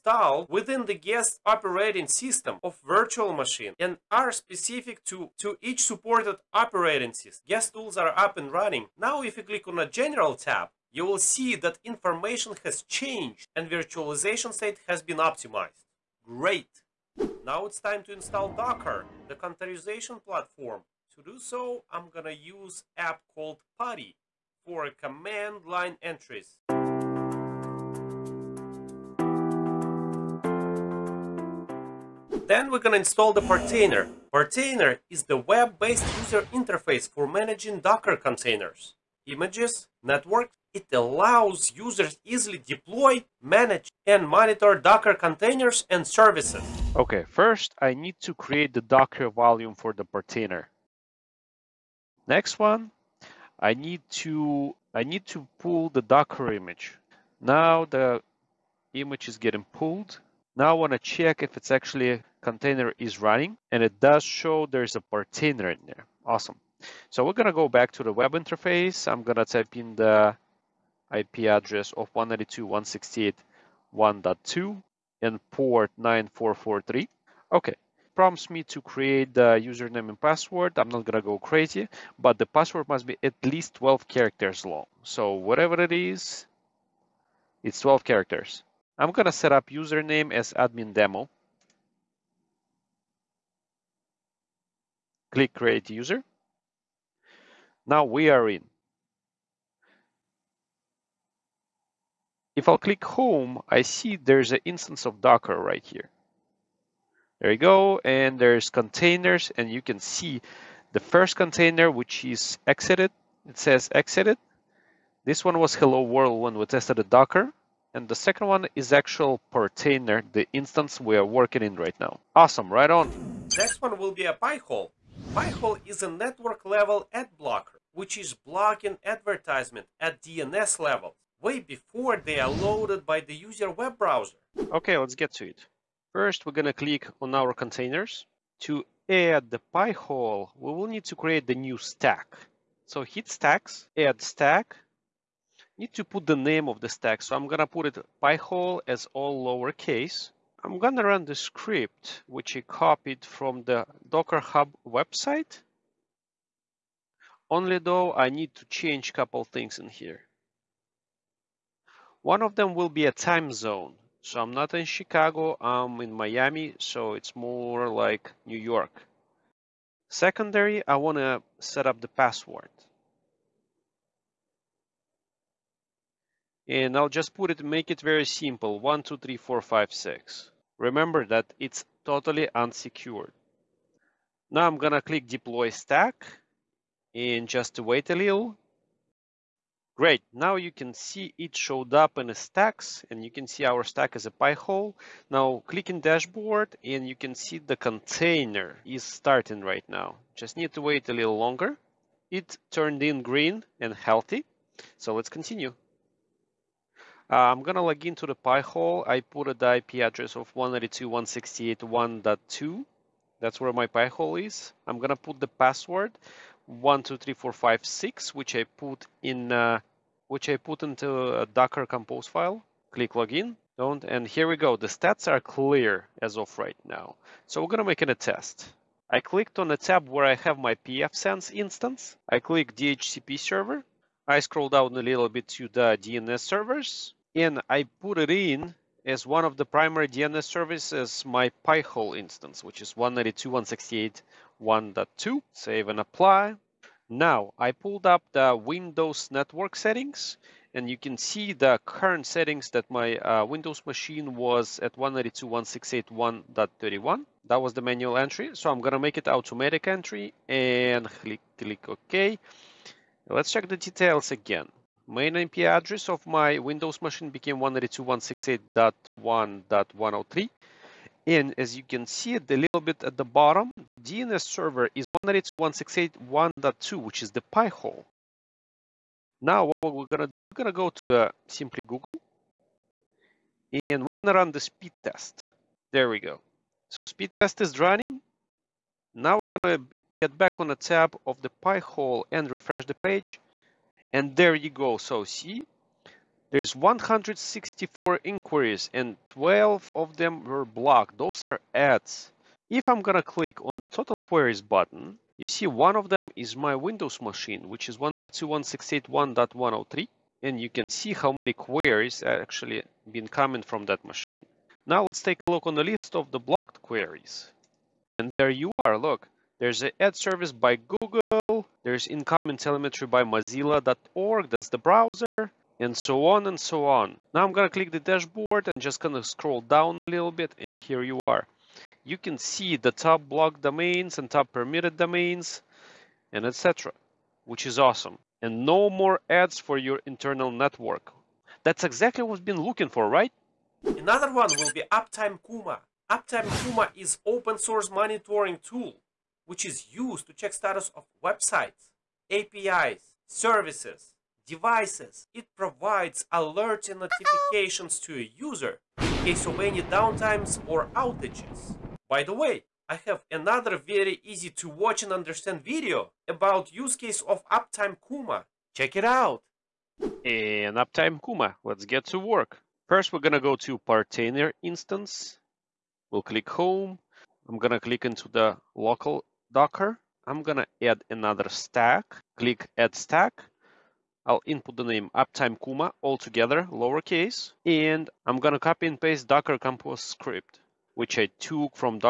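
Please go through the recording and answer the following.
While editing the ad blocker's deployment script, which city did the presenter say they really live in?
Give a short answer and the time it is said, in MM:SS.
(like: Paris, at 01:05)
Miami, at 02:46.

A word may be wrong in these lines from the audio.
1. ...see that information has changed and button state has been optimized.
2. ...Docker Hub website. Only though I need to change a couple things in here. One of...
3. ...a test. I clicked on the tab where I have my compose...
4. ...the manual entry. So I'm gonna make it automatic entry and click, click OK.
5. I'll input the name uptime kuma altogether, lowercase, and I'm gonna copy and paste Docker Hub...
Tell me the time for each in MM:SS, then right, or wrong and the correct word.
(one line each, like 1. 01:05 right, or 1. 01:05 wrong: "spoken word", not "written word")
1. 00:11 wrong: "virtualization", not "button"
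2. 02:34 right
3. 03:48 wrong: "pfSense", not "compose"
4. 04:17 right
5. 06:24 wrong: "Compose", not "Hub".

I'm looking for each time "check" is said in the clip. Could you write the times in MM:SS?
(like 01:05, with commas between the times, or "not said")
01:00, 04:23, 05:50, 06:08.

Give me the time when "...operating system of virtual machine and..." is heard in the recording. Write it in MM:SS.
00:01.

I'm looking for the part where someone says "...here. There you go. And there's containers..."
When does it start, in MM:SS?
01:45.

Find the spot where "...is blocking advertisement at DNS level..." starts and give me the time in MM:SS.
02:08.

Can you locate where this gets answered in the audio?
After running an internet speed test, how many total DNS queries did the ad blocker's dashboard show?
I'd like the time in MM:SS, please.
04:56.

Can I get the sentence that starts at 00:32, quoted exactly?
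Then we're gonna install the Portainer.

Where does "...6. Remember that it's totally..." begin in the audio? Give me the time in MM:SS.
02:59.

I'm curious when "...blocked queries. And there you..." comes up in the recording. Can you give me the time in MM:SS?
05:16.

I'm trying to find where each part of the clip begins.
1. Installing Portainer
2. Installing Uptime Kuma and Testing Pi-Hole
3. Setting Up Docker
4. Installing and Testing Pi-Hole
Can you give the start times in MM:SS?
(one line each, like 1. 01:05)
1. 00:33
2. 05:44
3. 00:18
4. 02:02.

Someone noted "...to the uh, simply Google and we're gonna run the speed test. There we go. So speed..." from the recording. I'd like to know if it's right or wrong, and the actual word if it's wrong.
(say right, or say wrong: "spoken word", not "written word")
right.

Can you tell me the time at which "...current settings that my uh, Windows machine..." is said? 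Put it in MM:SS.
04:11.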